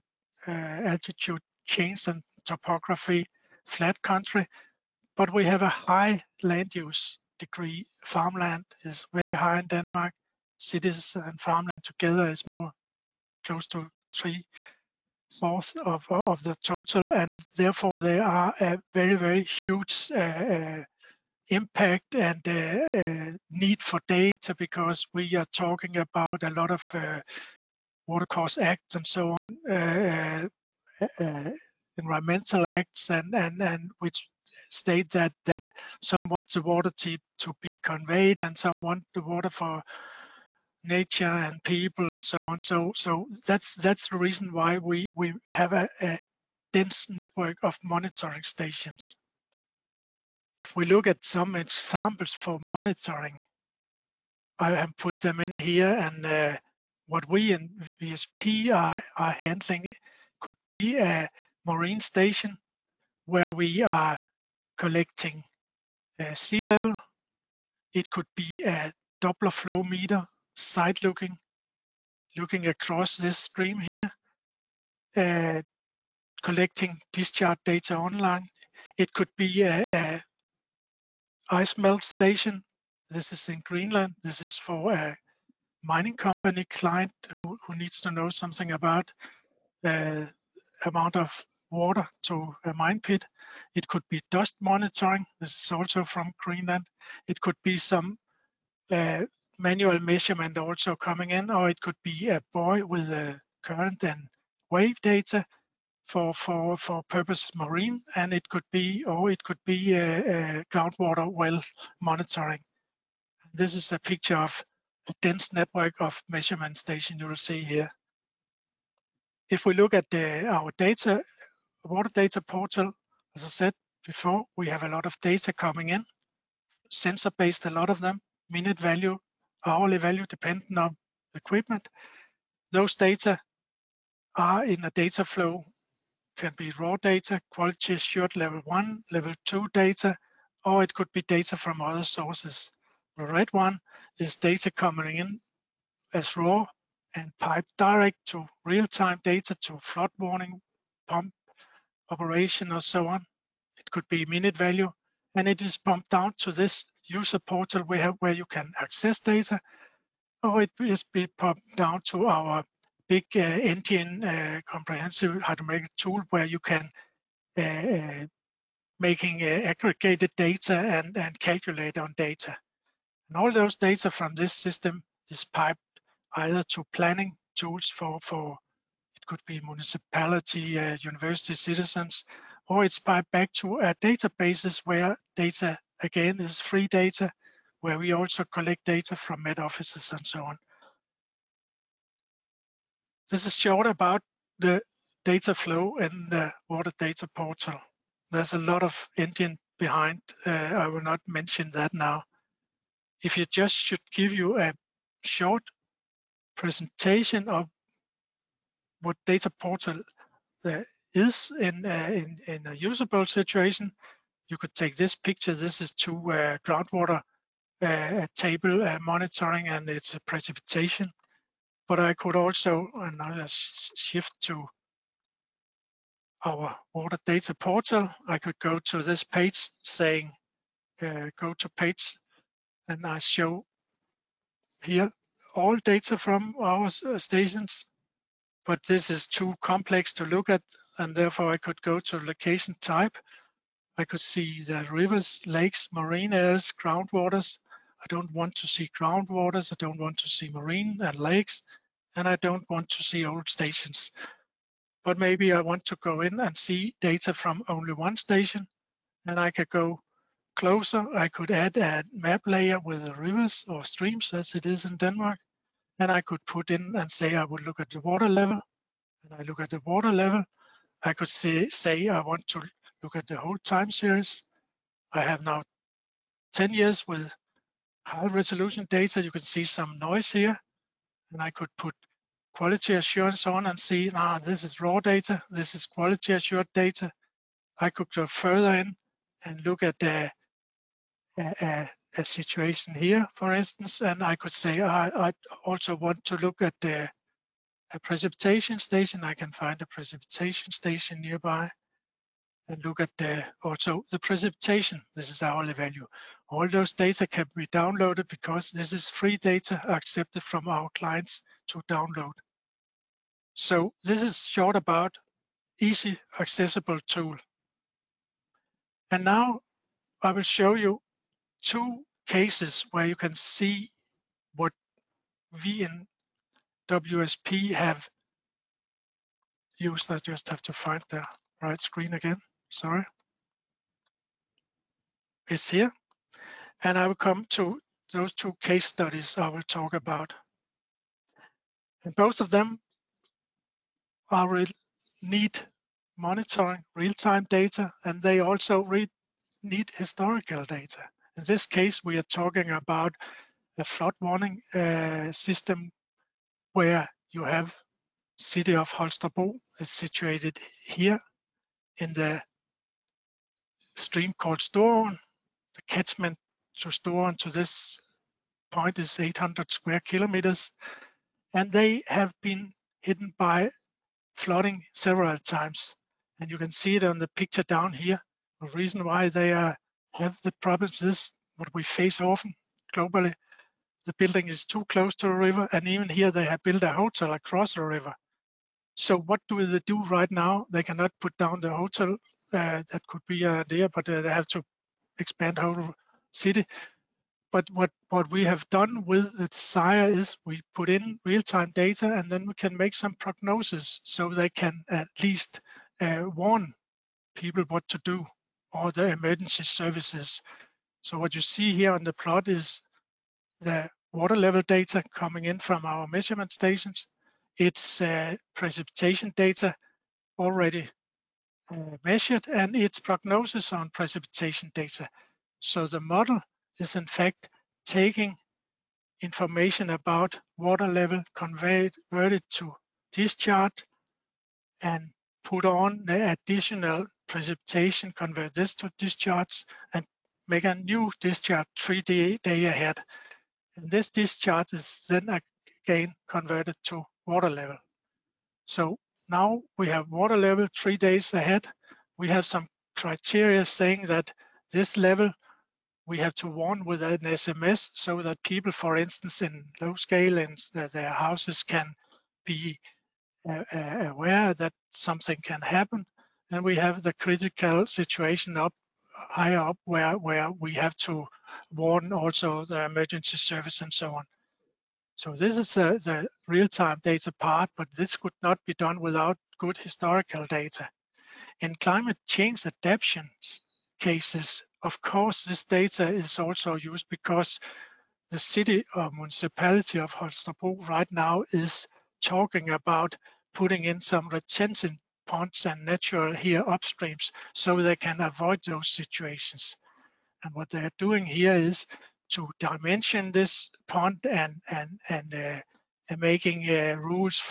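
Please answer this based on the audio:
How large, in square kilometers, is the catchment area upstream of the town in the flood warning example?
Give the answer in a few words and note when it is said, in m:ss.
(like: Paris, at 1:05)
800, at 6:09.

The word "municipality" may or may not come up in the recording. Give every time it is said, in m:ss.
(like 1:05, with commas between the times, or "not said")
2:59, 8:09.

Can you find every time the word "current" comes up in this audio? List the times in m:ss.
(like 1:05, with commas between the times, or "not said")
1:43.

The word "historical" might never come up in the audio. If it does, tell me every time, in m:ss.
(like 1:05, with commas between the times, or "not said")
5:49, 7:59.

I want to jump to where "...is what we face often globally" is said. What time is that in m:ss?
6:21.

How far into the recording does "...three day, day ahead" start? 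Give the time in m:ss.
7:21.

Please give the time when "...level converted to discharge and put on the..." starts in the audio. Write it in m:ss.
7:10.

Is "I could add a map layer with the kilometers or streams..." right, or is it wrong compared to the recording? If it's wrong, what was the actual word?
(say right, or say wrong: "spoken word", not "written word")
wrong: "rivers", not "kilometers".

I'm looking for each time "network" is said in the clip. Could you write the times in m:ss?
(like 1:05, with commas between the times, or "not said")
0:47, 1:55.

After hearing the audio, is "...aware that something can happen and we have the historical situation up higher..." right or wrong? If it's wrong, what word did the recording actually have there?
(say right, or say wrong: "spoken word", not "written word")
wrong: "critical", not "historical".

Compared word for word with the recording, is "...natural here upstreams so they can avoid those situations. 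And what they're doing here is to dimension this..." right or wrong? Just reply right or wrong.
right.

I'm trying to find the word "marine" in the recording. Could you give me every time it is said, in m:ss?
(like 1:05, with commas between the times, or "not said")
1:01, 1:47, 4:05, 4:10.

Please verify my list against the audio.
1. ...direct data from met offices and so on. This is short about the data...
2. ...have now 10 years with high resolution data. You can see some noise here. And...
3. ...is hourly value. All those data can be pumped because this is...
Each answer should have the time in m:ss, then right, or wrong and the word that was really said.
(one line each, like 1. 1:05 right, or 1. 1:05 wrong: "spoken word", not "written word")
1. 3:08 wrong: "collect", not "direct"
2. 4:35 right
3. 5:05 wrong: "downloaded", not "pumped".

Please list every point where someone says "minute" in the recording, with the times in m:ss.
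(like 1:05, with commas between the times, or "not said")
2:08, 2:34.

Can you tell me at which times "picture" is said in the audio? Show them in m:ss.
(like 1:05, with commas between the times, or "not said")
1:53, 3:35, 6:17.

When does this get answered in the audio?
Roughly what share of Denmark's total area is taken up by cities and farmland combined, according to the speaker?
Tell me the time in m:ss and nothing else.
0:14.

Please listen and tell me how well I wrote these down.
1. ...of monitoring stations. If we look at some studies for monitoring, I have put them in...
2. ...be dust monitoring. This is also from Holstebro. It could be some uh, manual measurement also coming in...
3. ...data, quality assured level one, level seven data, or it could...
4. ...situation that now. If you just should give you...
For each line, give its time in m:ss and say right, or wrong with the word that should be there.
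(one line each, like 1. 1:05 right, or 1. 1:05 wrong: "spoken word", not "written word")
1. 0:47 wrong: "examples", not "studies"
2. 1:34 wrong: "Greenland", not "Holstebro"
3. 2:16 wrong: "two", not "seven"
4. 3:21 wrong: "mention", not "situation".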